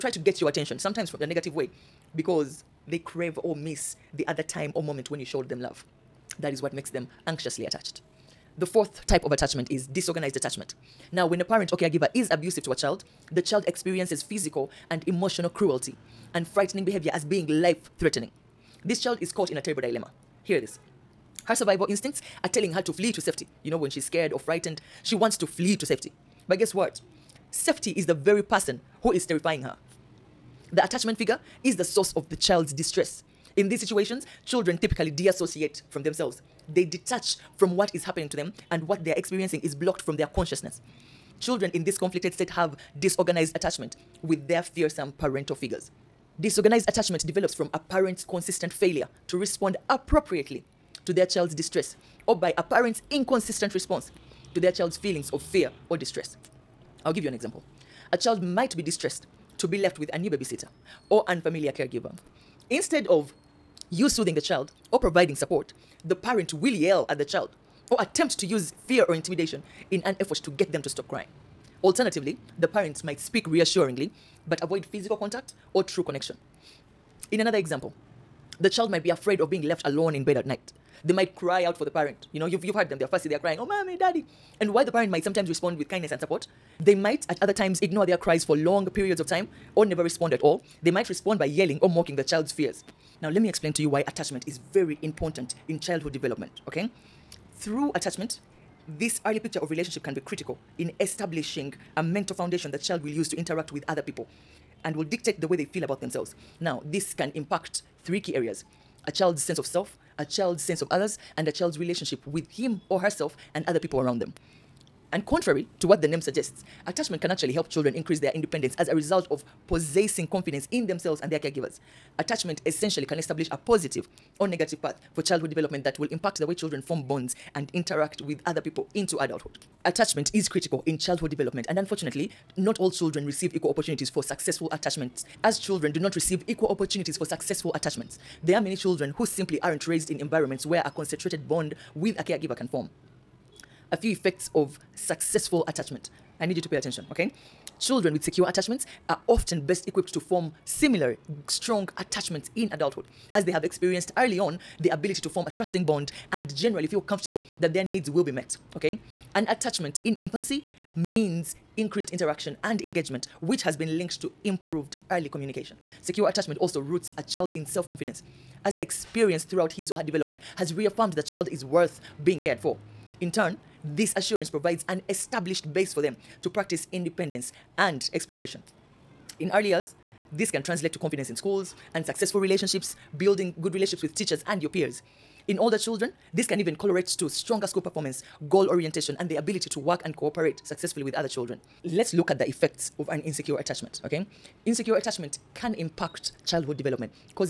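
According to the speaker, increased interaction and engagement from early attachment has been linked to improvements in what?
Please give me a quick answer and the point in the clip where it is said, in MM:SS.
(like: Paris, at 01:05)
early communication, at 02:45.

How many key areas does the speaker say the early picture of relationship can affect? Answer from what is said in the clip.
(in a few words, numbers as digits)
3.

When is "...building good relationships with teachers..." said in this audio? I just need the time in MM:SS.
03:03.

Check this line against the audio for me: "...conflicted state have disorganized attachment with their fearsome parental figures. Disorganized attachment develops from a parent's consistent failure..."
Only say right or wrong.
right.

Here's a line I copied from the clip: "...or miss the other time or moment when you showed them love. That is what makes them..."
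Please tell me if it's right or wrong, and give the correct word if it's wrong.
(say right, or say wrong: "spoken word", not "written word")
right.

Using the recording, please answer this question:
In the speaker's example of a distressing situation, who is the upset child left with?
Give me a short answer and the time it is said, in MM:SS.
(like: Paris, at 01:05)
a new babysitter, at 01:00.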